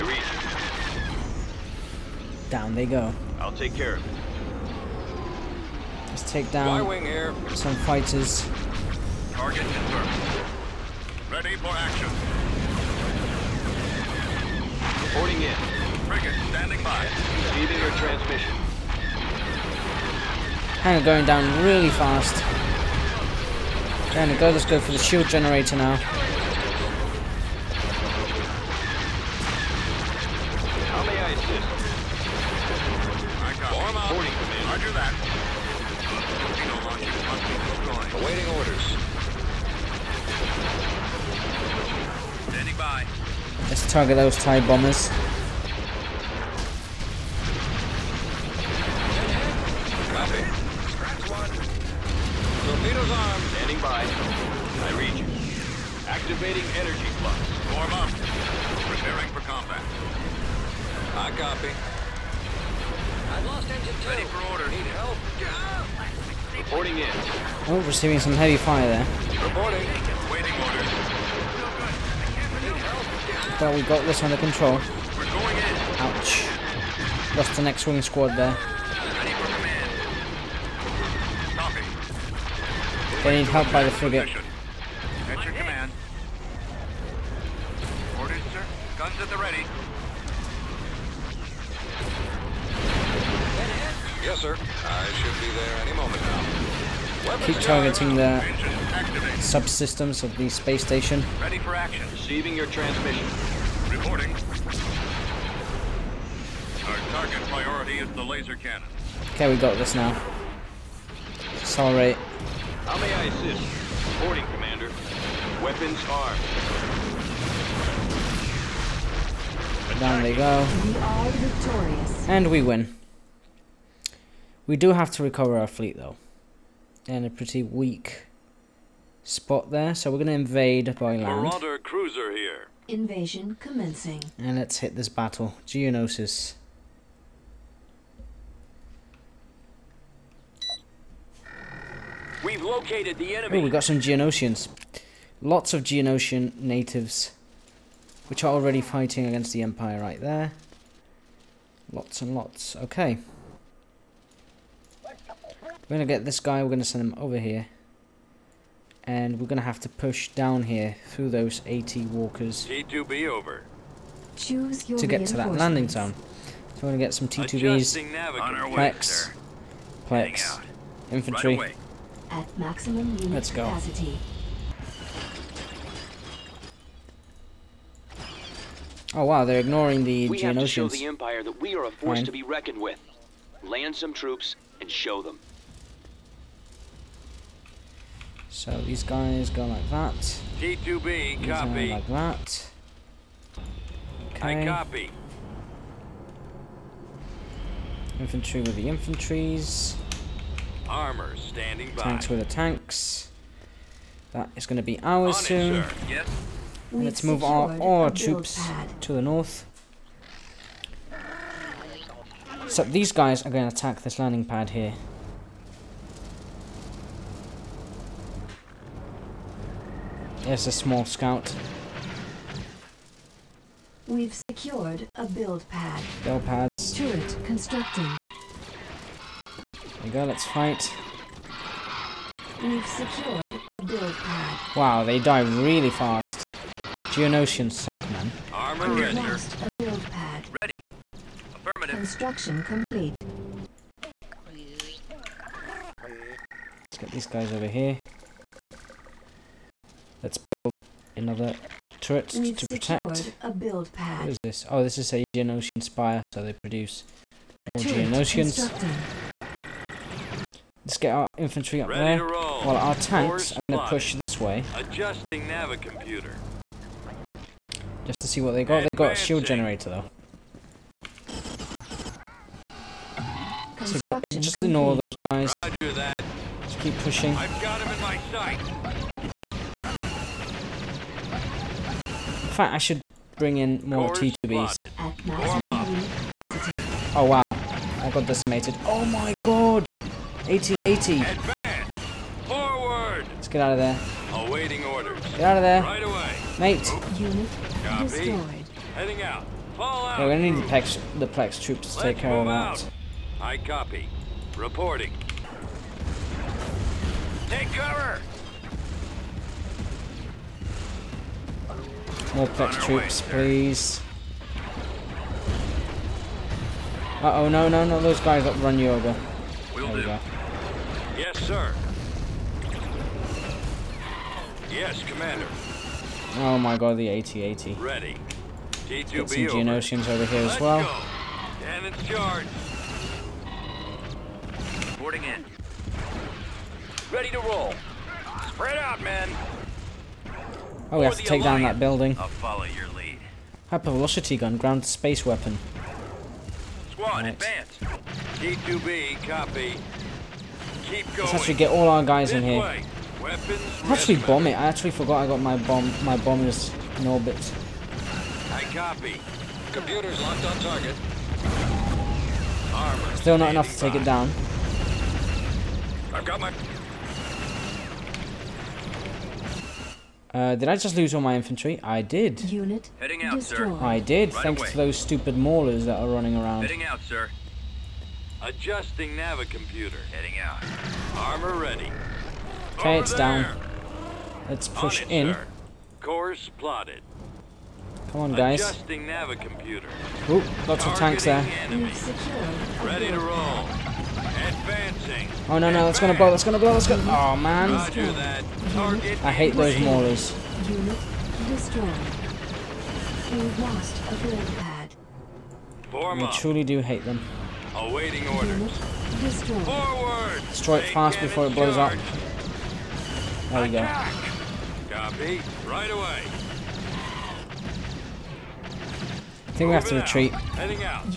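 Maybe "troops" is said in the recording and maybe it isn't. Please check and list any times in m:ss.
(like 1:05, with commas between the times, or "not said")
3:04, 3:28, 5:01, 5:12.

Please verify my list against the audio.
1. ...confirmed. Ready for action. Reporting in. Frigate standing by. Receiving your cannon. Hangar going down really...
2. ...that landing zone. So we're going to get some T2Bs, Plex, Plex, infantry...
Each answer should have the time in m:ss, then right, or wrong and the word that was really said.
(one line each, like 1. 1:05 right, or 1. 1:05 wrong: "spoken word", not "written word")
1. 0:09 wrong: "transmission", not "cannon"
2. 2:45 right.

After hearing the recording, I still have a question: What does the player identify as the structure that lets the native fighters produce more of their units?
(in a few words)
Geonosian spire.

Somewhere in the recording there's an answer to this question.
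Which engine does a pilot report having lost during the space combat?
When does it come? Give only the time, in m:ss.
1:03.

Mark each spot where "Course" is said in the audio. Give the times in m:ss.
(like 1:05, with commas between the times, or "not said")
4:44, 6:25.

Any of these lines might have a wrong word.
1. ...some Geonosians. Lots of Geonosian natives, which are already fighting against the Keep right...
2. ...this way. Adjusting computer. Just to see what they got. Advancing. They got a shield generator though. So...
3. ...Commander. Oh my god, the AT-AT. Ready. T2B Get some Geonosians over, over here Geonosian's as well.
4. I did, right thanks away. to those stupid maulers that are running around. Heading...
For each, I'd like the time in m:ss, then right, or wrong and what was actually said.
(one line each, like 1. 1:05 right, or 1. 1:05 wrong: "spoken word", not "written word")
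1. 2:23 wrong: "Empire", not "Keep"
2. 4:24 right
3. 5:25 wrong: "Let", not "Geonosian"
4. 6:13 right.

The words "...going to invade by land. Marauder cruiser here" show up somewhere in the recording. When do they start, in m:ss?
2:10.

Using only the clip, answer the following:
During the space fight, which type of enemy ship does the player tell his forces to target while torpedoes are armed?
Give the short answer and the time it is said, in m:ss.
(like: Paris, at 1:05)
TIE bombers, at 0:44.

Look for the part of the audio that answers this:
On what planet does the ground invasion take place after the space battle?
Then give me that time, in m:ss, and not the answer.
2:15.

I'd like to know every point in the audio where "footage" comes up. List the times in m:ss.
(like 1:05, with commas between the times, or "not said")
not said.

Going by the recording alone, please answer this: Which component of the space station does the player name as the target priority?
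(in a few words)
Laser cannon.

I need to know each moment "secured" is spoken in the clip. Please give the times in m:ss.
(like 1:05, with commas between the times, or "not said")
3:44, 3:52.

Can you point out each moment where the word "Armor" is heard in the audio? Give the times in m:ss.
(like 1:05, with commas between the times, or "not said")
3:20, 3:58, 6:02, 6:21.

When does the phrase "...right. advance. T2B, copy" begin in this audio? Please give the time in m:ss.
5:47.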